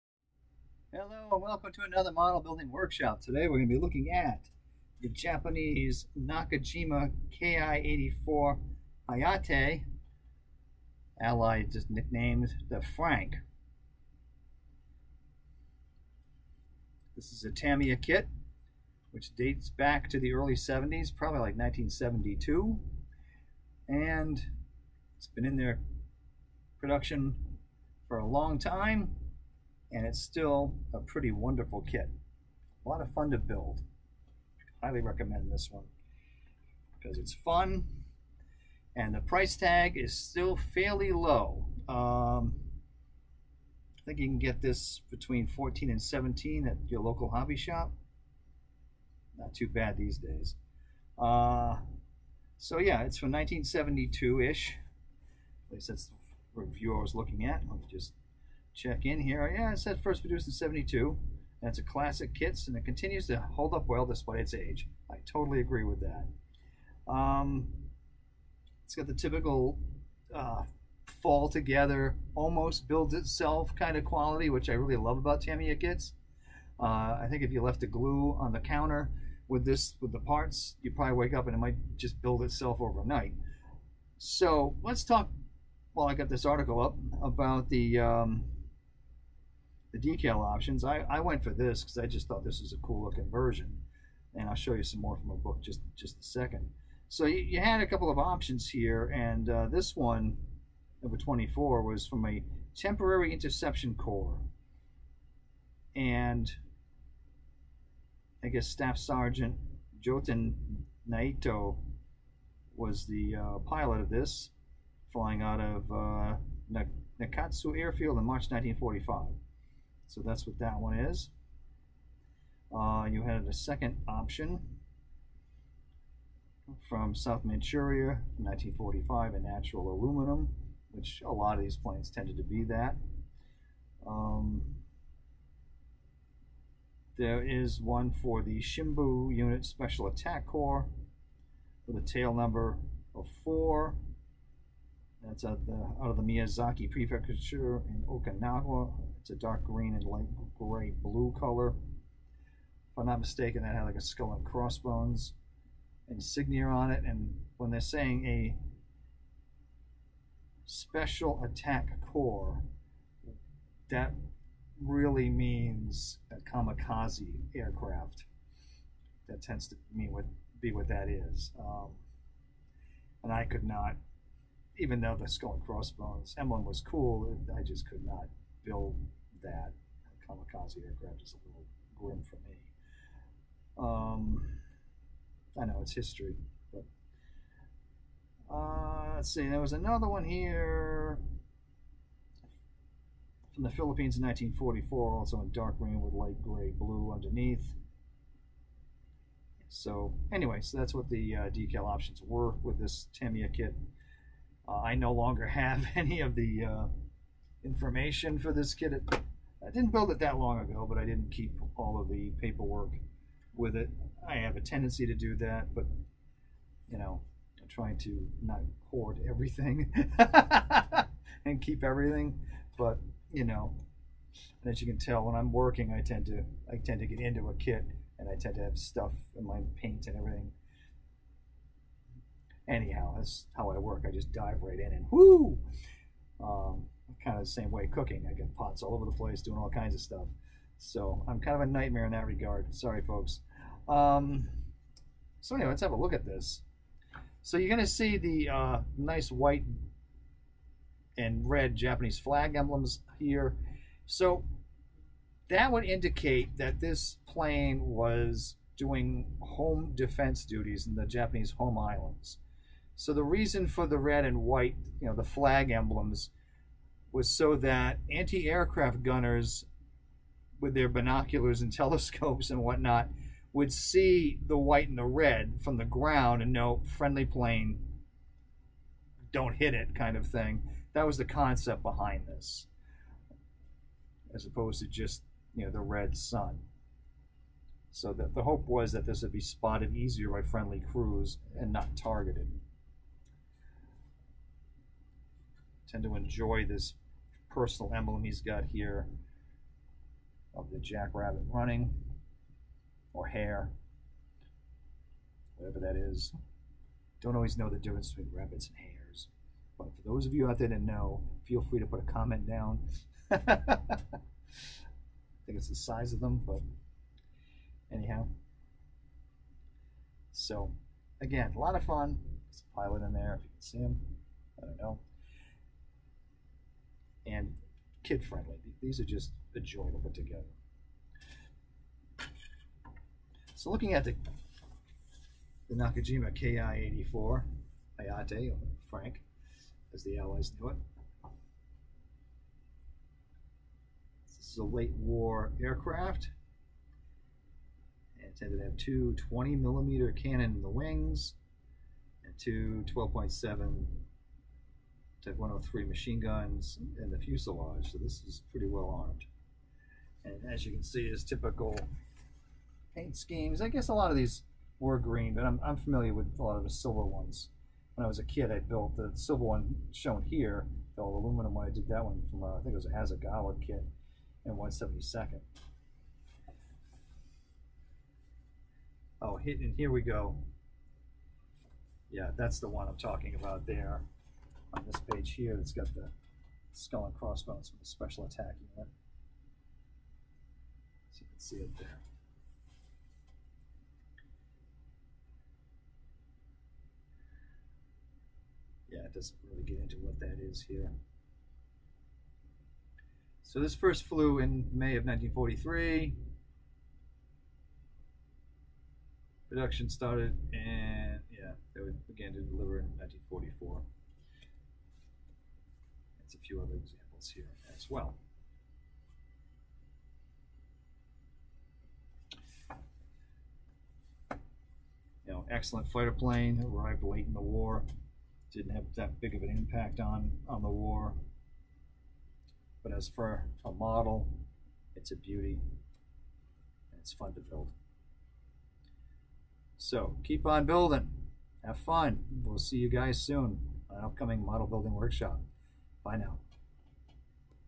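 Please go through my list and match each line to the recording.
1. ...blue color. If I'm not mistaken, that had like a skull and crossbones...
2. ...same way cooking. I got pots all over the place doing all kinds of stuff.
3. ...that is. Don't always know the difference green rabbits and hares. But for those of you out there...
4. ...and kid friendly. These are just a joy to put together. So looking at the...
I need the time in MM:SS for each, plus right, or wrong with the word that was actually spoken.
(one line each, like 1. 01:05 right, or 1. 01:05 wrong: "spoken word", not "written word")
1. 02:31 right
2. 03:57 right
3. 05:05 wrong: "between", not "green"
4. 05:27 right.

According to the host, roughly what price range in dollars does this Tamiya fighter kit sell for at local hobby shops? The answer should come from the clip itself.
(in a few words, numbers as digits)
14 to 17.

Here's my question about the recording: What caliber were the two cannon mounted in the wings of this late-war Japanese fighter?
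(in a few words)
20 millimeter.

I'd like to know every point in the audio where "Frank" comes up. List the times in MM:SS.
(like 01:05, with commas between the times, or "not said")
00:12, 05:38.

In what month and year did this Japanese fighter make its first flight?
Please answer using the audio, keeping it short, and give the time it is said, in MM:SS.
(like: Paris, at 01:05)
May 1943, at 06:44.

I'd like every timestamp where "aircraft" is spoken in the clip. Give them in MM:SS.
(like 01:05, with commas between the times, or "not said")
02:47, 03:00, 04:28, 05:45.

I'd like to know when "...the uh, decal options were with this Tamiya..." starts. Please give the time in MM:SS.
03:21.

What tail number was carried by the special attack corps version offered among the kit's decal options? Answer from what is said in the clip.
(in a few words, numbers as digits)
4.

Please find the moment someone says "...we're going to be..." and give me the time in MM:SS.
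00:03.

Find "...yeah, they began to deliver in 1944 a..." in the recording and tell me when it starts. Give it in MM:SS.
06:51.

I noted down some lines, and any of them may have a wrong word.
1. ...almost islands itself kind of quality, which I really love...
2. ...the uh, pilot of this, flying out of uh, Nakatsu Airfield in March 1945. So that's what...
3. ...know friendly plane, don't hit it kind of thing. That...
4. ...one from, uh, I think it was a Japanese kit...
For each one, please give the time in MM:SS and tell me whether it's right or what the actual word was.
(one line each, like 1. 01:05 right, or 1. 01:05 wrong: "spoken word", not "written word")
1. 01:12 wrong: "builds", not "islands"
2. 01:53 right
3. 04:36 right
4. 06:12 wrong: "Hasegawa", not "Japanese".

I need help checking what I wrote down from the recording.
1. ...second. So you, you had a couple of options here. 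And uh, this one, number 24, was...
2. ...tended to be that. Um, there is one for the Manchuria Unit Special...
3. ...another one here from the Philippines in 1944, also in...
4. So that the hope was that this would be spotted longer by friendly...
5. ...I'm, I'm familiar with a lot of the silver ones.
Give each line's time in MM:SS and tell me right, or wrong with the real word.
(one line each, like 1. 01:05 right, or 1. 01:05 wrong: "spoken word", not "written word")
1. 01:36 right
2. 02:12 wrong: "Shimbu", not "Manchuria"
3. 03:09 right
4. 04:47 wrong: "easier", not "longer"
5. 06:05 right.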